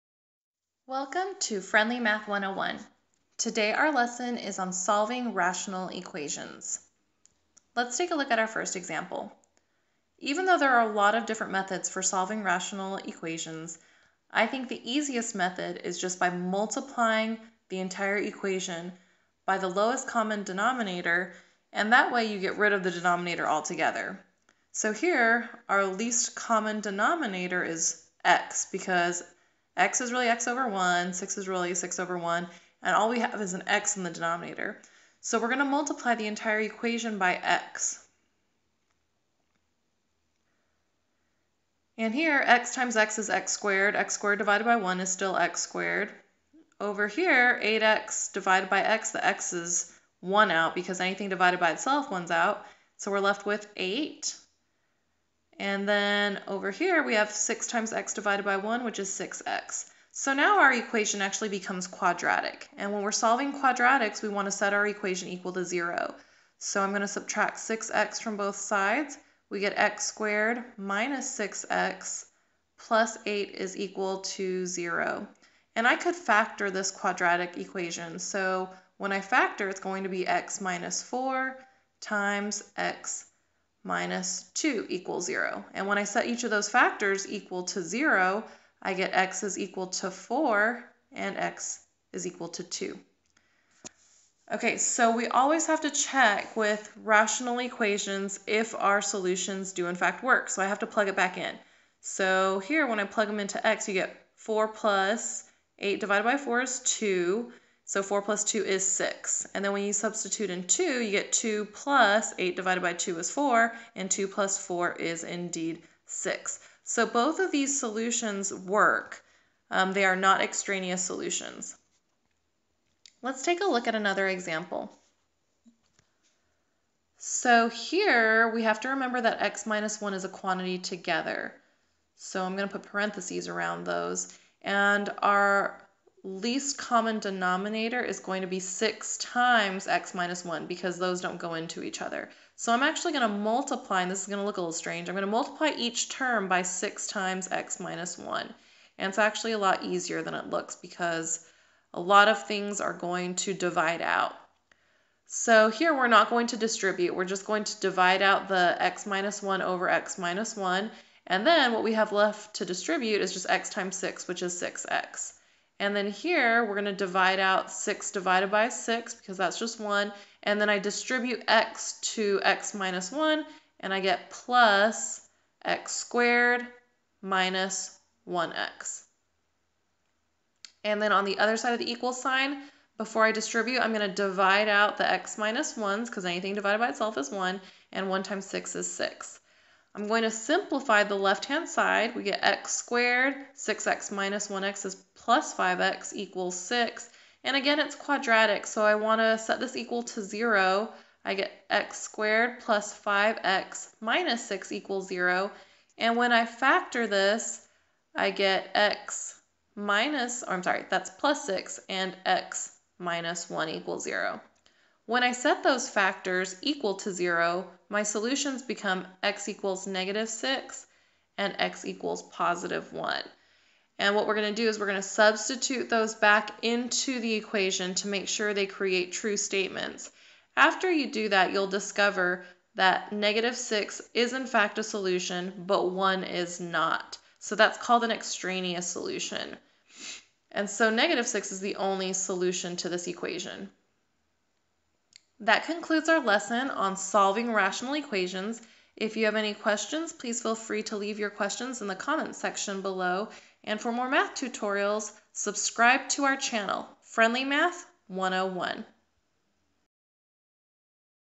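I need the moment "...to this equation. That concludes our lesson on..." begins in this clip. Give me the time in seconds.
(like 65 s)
242 s.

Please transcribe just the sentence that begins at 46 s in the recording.
Over here, 8x divided by x, the x is 1 out because anything divided by itself, 1's out.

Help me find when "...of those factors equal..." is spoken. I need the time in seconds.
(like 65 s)
86 s.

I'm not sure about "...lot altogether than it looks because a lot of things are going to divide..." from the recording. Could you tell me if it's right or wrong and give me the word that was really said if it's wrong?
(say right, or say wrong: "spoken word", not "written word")
wrong: "easier", not "altogether".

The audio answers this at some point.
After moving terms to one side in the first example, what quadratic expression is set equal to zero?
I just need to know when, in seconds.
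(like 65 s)
69 s.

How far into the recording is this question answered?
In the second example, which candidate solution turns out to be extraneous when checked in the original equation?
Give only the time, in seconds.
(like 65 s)
235 s.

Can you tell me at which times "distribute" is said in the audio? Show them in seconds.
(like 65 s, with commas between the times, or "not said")
156 s, 162 s, 170 s, 183 s.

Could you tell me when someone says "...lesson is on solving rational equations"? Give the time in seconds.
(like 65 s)
3 s.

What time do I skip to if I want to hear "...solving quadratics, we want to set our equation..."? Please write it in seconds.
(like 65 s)
63 s.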